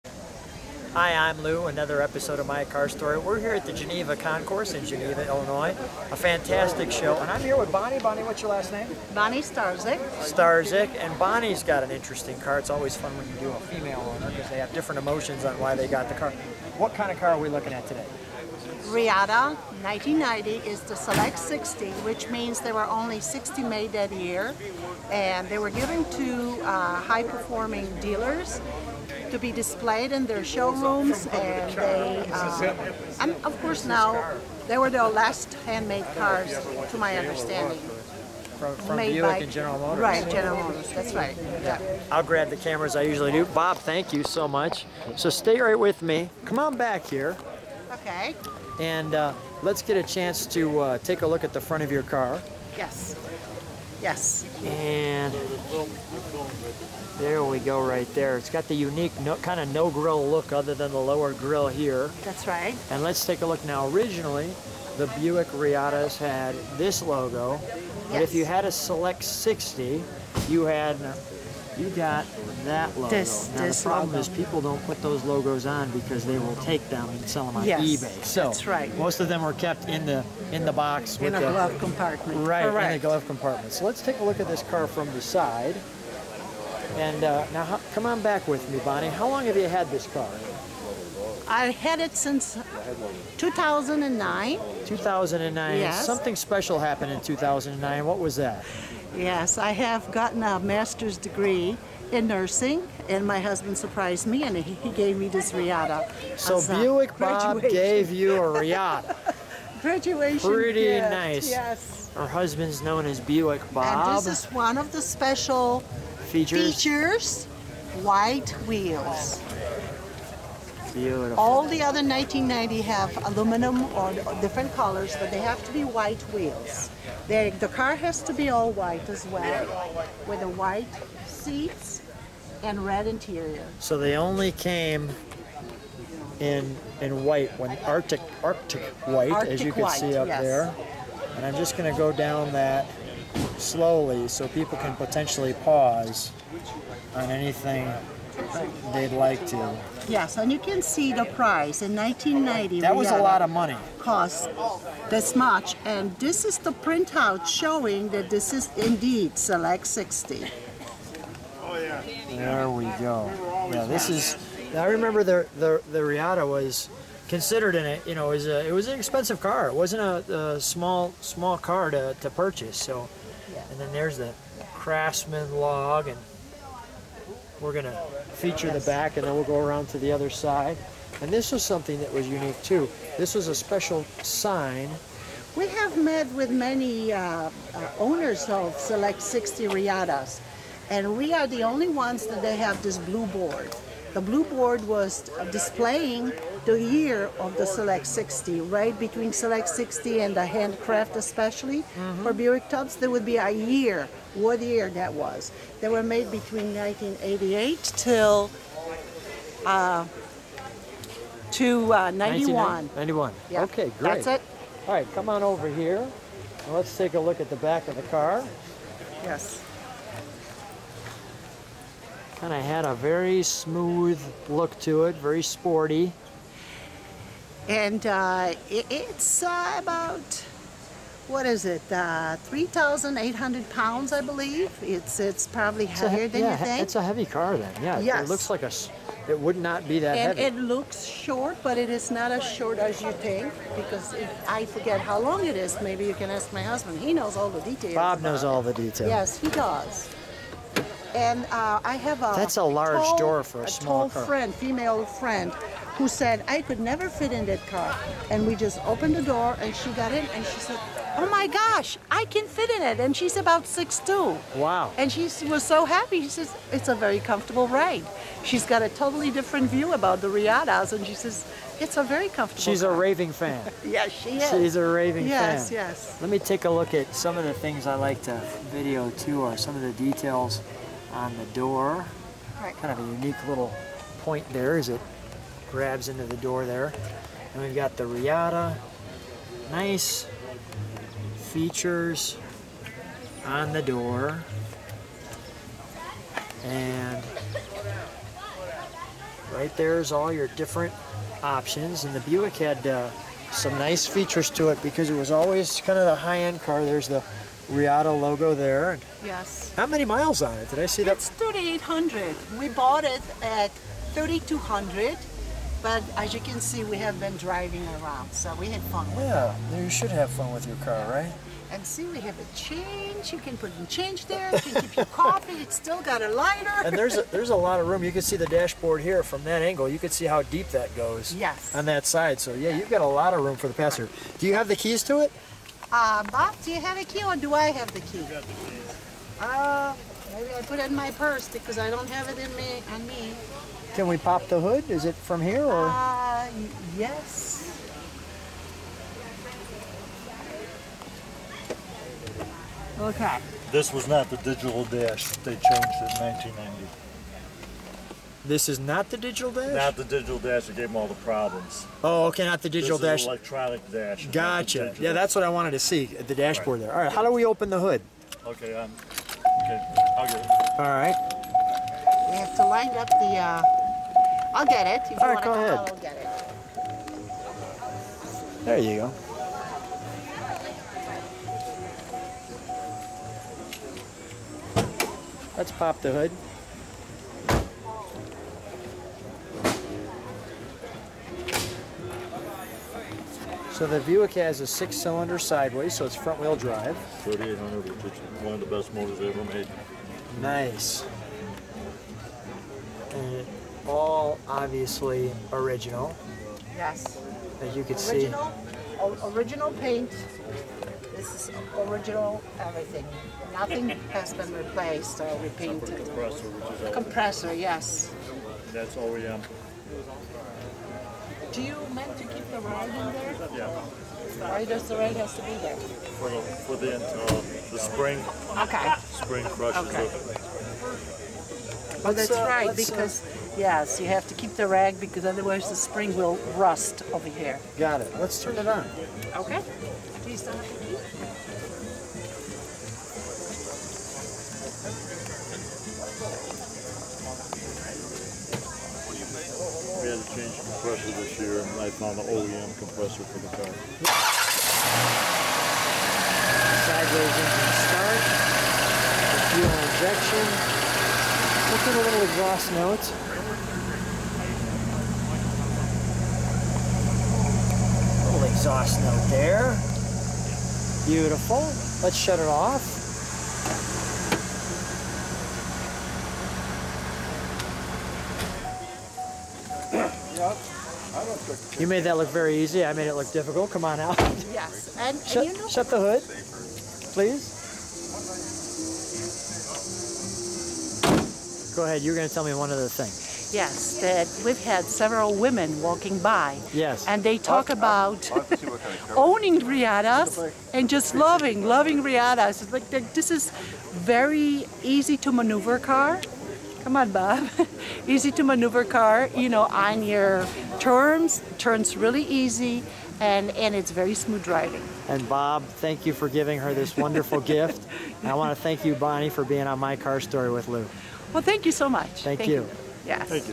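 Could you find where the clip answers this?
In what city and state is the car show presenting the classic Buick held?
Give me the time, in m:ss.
0:04.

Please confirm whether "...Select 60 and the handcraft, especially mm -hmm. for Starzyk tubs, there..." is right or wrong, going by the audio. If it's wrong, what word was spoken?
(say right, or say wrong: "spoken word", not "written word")
wrong: "Buick", not "Starzyk".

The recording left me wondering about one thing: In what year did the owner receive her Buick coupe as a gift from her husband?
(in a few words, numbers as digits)
2009.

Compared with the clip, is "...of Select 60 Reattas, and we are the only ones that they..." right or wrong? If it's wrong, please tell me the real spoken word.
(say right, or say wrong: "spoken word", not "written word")
right.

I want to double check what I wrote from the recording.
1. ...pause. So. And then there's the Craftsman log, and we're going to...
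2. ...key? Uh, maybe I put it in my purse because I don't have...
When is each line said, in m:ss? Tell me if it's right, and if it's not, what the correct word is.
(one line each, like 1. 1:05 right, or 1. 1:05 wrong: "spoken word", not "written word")
1. 2:52 wrong: "purchase", not "pause"
2. 5:37 right.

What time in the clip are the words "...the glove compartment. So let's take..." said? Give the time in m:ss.
1:23.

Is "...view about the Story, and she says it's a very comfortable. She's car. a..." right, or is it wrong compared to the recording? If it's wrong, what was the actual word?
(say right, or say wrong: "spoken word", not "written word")
wrong: "Reattas", not "Story".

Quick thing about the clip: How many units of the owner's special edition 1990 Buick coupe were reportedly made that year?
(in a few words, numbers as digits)
60.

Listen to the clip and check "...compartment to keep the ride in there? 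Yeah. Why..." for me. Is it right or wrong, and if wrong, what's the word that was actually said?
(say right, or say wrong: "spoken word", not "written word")
wrong: "meant", not "compartment".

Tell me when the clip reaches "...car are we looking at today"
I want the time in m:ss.
0:17.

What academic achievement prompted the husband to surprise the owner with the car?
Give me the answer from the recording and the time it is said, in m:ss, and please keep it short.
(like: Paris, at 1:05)
master's degree in nursing, at 1:40.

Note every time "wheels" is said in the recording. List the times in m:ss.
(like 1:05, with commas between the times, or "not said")
1:58, 2:06, 6:36.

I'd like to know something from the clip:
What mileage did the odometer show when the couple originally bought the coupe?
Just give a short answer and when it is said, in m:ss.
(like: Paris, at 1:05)
3,200, at 5:14.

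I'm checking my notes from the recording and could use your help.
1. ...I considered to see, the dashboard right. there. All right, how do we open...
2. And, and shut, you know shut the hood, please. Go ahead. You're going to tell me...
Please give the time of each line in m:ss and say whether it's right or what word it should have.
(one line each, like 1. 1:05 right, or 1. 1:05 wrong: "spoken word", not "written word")
1. 6:05 wrong: "wanted", not "considered"
2. 8:04 right.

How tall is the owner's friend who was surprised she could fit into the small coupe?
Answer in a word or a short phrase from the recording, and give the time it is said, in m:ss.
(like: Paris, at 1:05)
six two, at 4:23.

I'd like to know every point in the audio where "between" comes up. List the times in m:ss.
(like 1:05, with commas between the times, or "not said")
3:18, 3:26.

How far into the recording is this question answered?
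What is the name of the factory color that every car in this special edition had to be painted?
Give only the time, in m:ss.
2:18.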